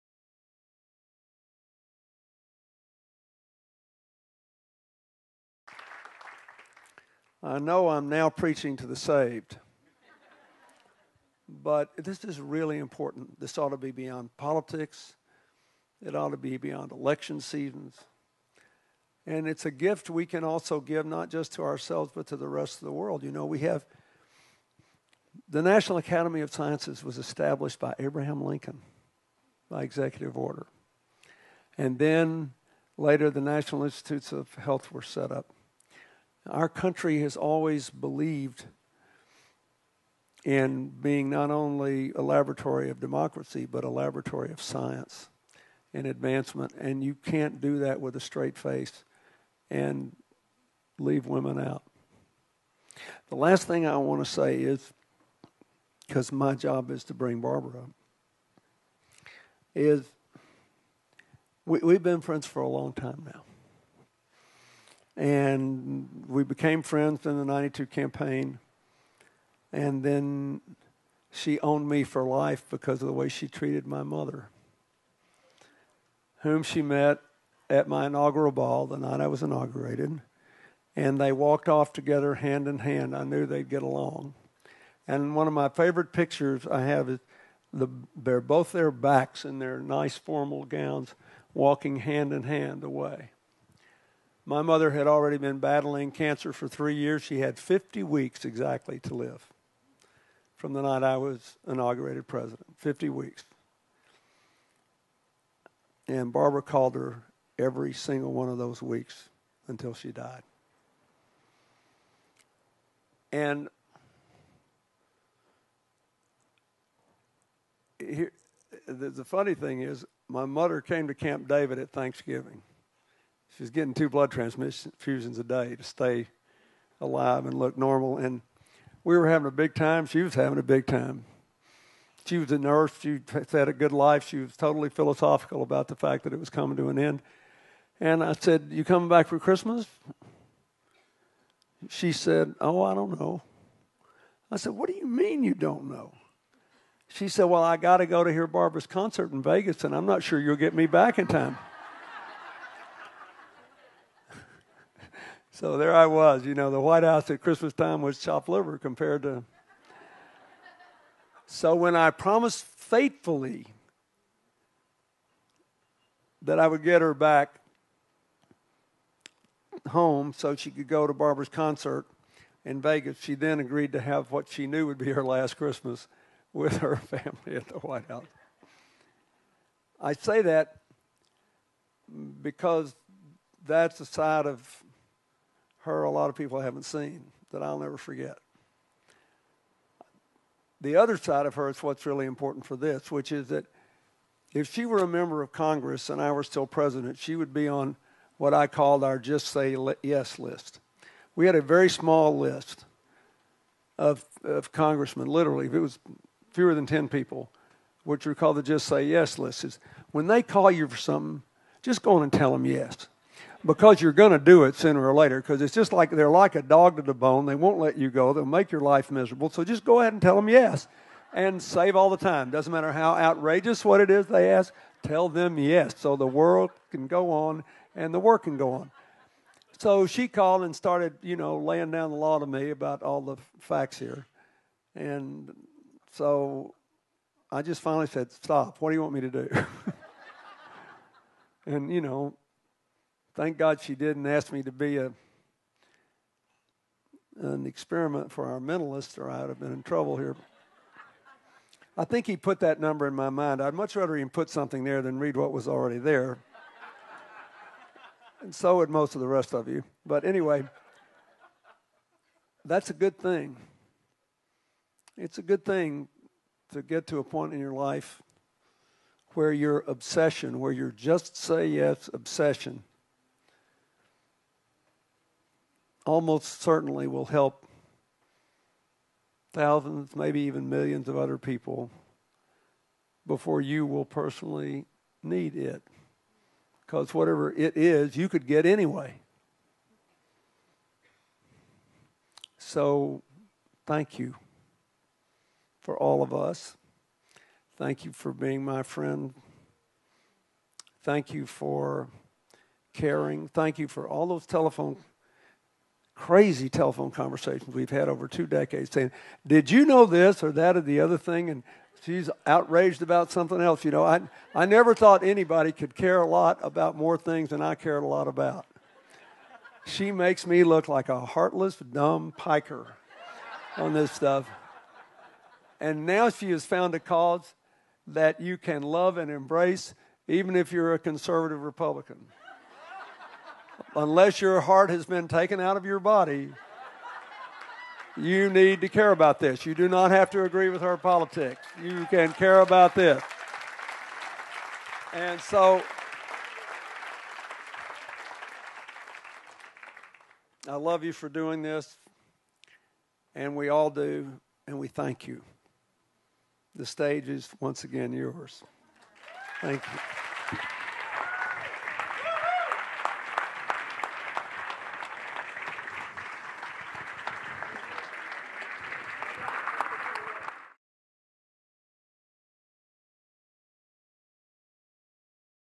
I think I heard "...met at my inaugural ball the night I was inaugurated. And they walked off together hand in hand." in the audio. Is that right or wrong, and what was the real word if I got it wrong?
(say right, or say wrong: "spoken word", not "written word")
right.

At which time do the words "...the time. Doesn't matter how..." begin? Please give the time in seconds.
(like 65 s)
222 s.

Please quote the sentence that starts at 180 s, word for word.
I say that because that's the side of her a lot of people haven't seen that I'll never forget.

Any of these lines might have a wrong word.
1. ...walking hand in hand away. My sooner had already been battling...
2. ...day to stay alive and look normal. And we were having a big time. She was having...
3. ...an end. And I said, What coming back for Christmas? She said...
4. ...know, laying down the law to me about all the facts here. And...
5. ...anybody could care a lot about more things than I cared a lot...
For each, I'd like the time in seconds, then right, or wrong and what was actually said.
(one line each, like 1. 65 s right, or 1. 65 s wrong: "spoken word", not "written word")
1. 91 s wrong: "mother", not "sooner"
2. 125 s right
3. 136 s wrong: "You", not "What"
4. 231 s right
5. 315 s right.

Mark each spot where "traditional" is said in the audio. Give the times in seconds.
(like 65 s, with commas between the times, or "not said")
not said.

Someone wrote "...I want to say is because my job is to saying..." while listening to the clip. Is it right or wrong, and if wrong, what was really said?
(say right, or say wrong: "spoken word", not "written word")
wrong: "bring", not "saying".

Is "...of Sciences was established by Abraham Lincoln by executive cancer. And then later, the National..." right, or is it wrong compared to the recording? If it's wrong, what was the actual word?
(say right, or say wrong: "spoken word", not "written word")
wrong: "order", not "cancer".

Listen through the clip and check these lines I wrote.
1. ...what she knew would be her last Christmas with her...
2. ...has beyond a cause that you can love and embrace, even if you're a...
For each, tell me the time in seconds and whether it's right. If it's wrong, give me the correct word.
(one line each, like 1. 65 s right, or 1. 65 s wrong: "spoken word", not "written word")
1. 174 s right
2. 326 s wrong: "found", not "beyond".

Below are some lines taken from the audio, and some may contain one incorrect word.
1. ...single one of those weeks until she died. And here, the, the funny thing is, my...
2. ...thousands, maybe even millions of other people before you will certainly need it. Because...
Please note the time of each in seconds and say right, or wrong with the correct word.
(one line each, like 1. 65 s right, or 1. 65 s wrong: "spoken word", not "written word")
1. 107 s right
2. 279 s wrong: "personally", not "certainly".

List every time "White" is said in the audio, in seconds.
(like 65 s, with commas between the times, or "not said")
156 s, 177 s.